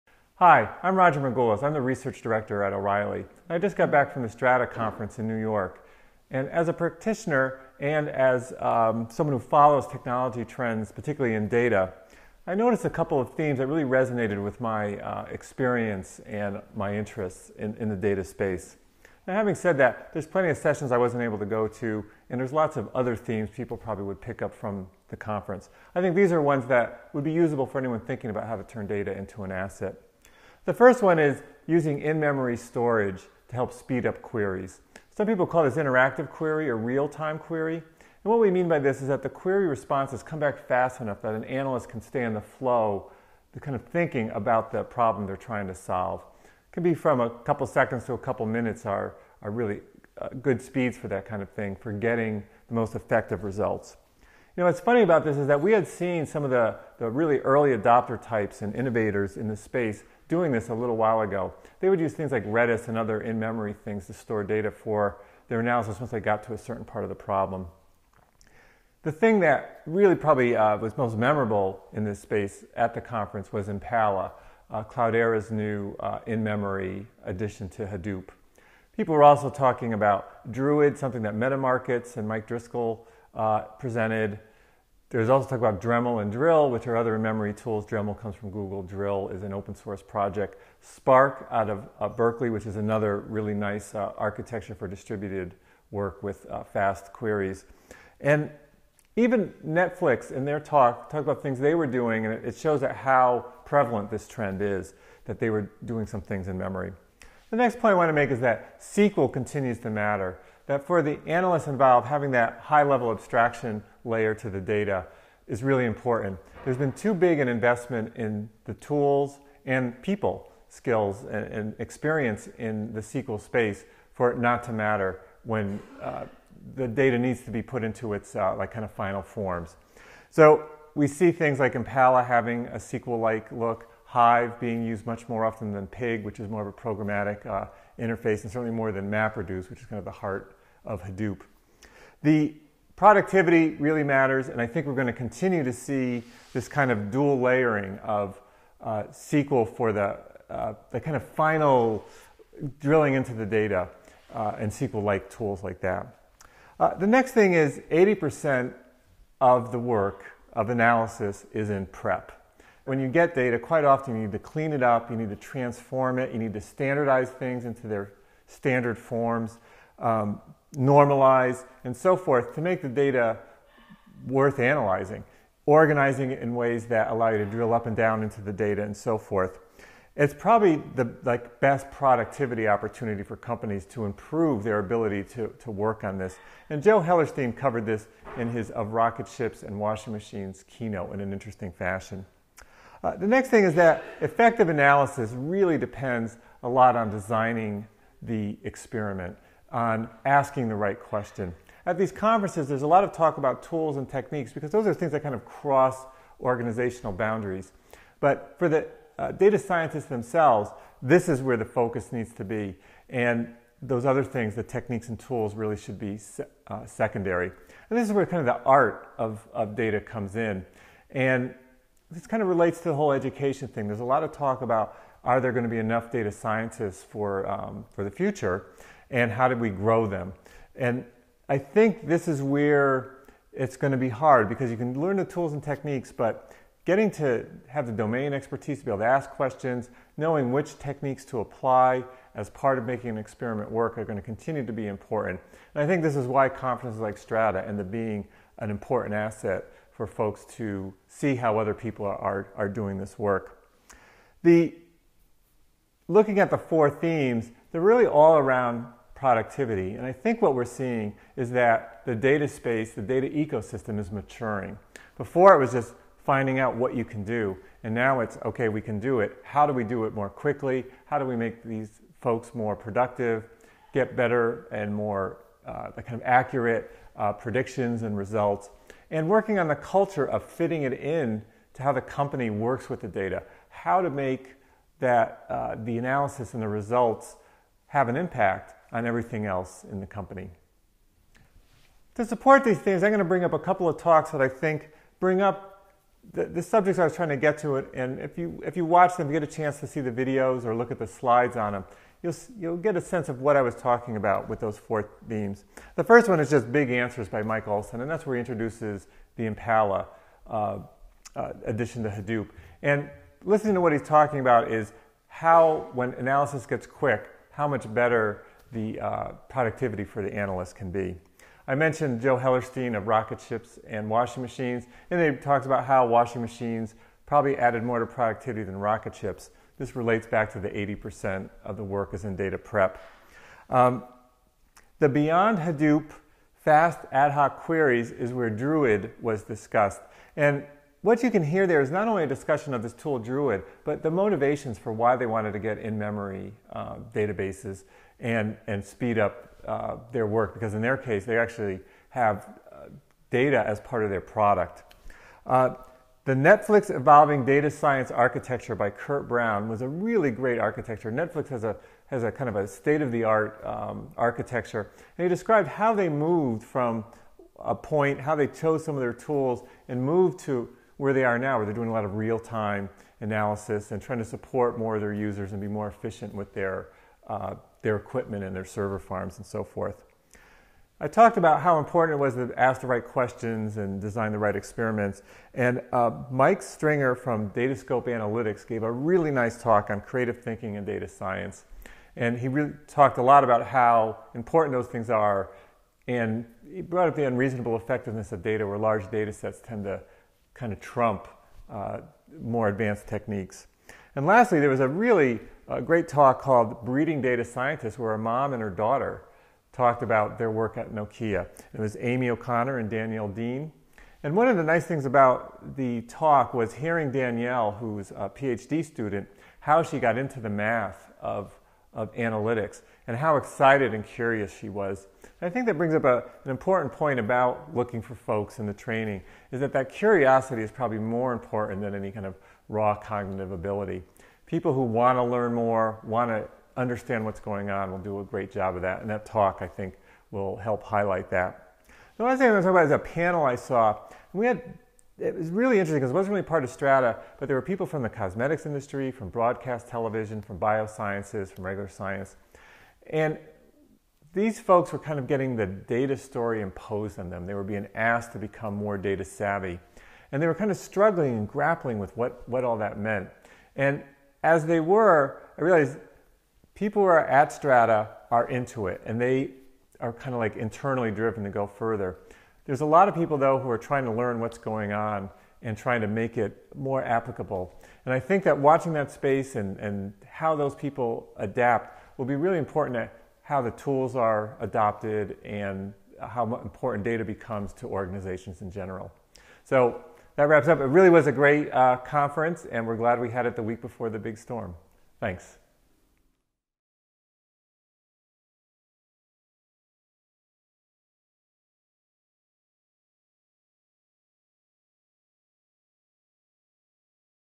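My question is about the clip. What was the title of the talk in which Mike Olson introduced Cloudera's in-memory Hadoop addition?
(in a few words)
Big Answers.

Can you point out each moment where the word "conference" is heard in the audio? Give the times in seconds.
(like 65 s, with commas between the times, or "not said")
4 s, 25 s, 73 s, 202 s, 246 s, 491 s.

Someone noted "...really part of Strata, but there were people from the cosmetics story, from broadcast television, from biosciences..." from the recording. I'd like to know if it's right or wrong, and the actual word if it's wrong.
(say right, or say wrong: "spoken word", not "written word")
wrong: "industry", not "story".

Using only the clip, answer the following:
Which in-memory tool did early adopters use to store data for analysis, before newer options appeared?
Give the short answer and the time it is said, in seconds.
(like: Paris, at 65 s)
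Redis, at 62 s.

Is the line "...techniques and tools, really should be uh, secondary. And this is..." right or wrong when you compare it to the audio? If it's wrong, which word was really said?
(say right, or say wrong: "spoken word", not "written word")
right.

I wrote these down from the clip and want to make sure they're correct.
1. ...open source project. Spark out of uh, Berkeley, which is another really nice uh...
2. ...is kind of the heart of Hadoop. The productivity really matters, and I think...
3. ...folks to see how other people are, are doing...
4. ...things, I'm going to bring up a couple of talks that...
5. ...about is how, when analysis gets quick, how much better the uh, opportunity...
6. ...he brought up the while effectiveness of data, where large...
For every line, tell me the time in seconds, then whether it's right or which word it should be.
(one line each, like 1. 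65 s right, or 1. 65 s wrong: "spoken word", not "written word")
1. 89 s right
2. 139 s right
3. 250 s right
4. 292 s right
5. 314 s wrong: "productivity", not "opportunity"
6. 396 s wrong: "unreasonable", not "while".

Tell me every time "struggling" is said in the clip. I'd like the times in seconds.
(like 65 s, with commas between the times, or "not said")
460 s.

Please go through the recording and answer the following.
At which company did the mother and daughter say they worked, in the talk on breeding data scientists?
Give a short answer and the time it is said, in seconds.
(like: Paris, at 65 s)
Nokia, at 410 s.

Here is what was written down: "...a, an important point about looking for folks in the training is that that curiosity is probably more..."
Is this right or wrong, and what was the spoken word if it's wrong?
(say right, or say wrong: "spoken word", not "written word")
right.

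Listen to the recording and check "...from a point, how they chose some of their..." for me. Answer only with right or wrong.
right.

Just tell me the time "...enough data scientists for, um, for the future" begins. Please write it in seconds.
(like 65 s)
225 s.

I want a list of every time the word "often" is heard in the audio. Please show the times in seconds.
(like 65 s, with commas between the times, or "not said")
135 s, 163 s.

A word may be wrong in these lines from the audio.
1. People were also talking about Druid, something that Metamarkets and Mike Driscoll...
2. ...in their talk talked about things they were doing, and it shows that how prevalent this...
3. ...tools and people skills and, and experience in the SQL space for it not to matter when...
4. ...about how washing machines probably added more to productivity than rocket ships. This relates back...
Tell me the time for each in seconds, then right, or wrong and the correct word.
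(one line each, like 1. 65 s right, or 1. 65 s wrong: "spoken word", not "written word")
1. 78 s right
2. 100 s right
3. 118 s right
4. 325 s right.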